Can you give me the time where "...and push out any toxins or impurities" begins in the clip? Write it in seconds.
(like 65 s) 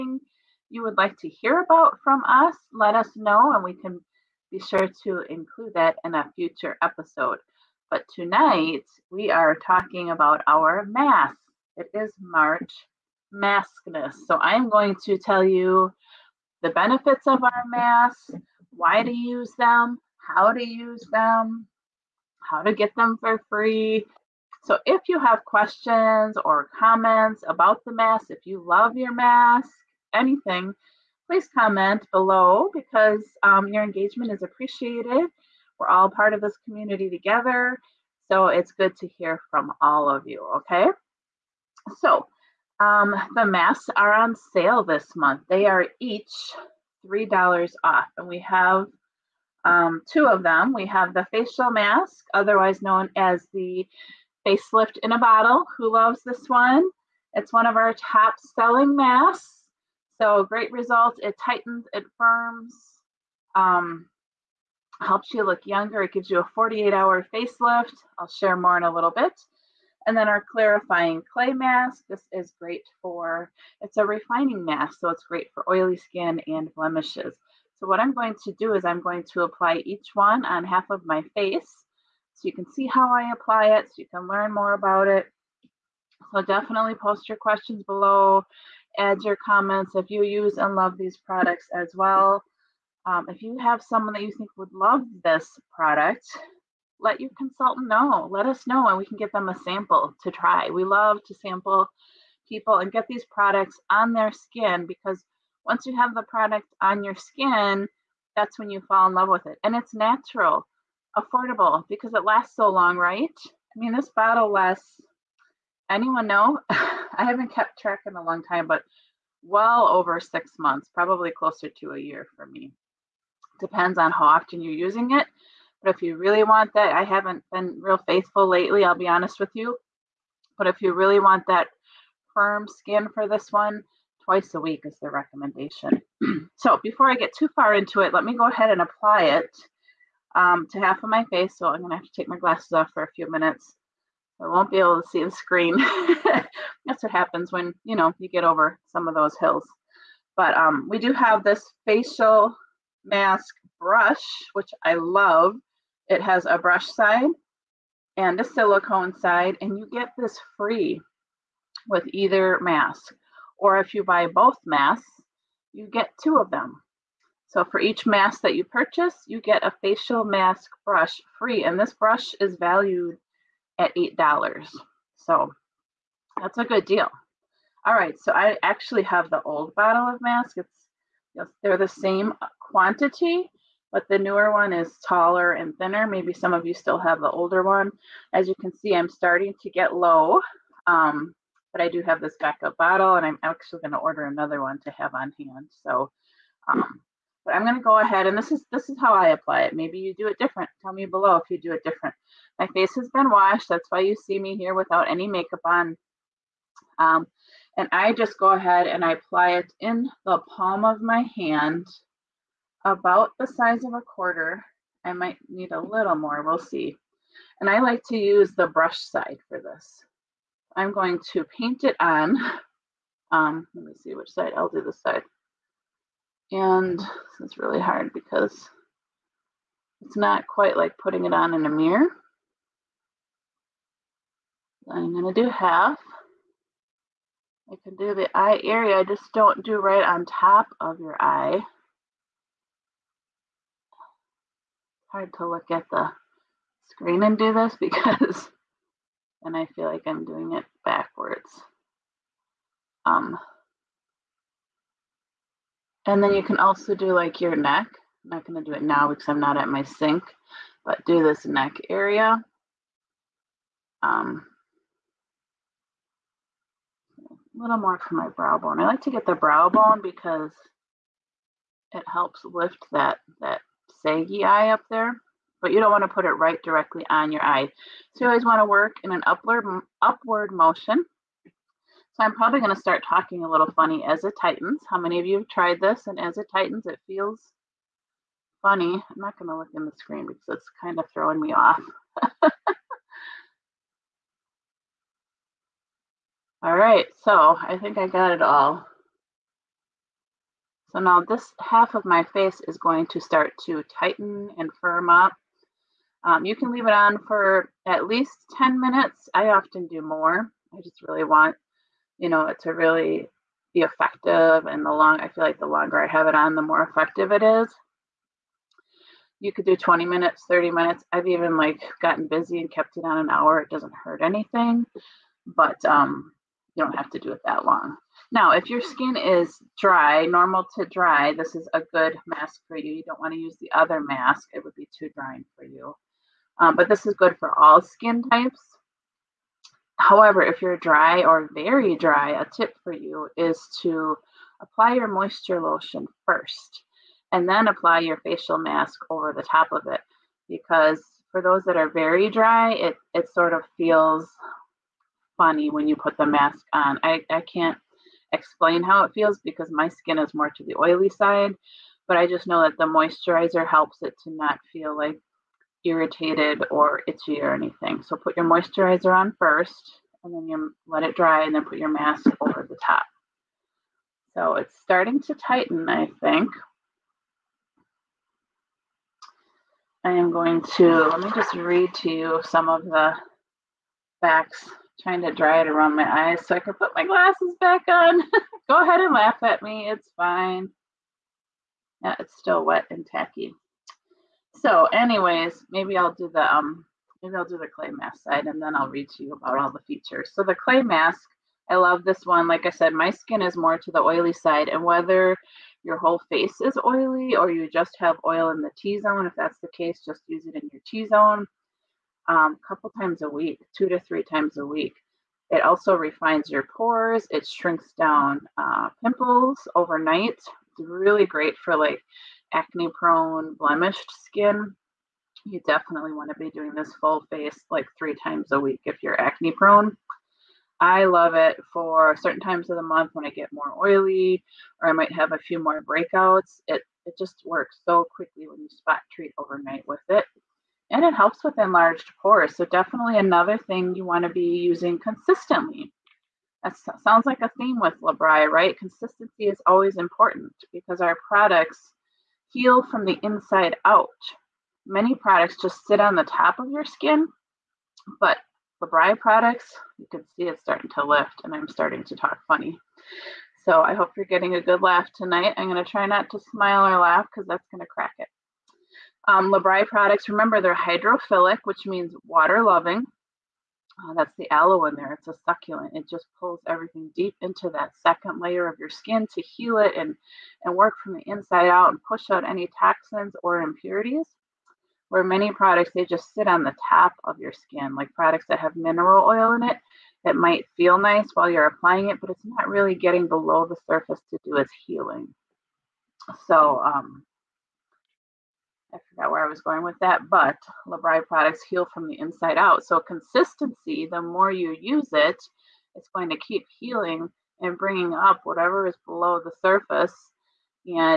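481 s.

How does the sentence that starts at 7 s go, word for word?
But tonight, we are talking about our mask.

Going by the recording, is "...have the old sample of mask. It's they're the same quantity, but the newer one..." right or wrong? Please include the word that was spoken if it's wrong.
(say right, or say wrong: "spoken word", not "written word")
wrong: "bottle", not "sample".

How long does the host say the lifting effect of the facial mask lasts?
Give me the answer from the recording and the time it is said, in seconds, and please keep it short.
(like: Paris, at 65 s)
48 hours, at 66 s.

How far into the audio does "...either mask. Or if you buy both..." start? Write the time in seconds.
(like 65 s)
162 s.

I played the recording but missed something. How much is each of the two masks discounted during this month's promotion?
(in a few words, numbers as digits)
$3.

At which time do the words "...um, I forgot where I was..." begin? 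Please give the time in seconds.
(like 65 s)
496 s.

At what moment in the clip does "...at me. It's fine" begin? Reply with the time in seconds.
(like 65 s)
389 s.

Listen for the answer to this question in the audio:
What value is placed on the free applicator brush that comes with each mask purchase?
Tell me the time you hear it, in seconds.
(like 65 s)
173 s.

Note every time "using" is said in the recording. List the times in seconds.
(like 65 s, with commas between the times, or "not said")
124 s, 444 s.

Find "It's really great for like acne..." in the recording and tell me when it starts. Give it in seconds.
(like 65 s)
420 s.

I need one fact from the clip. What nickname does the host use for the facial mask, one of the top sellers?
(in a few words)
facelift in a bottle.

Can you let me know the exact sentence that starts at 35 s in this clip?
We're all part of this community together.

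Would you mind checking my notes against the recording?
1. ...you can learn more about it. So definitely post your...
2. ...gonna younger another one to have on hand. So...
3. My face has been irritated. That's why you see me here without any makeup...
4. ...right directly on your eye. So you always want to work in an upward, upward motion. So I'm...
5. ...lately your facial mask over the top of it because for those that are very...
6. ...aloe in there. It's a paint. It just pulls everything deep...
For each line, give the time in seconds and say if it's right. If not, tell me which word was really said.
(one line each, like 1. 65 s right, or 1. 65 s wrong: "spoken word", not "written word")
1. 83 s right
2. 193 s wrong: "order", not "younger"
3. 202 s wrong: "washed", not "irritated"
4. 276 s right
5. 347 s wrong: "apply", not "lately"
6. 474 s wrong: "succulent", not "paint".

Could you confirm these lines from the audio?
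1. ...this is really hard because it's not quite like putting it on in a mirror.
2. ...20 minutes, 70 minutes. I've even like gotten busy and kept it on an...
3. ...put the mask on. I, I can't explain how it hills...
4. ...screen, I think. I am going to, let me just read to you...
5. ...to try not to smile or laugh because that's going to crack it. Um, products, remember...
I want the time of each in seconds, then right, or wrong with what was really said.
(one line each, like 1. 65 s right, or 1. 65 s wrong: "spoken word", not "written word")
1. 226 s right
2. 319 s wrong: "30", not "70"
3. 355 s wrong: "feels", not "hills"
4. 375 s wrong: "tighten", not "screen"
5. 465 s right.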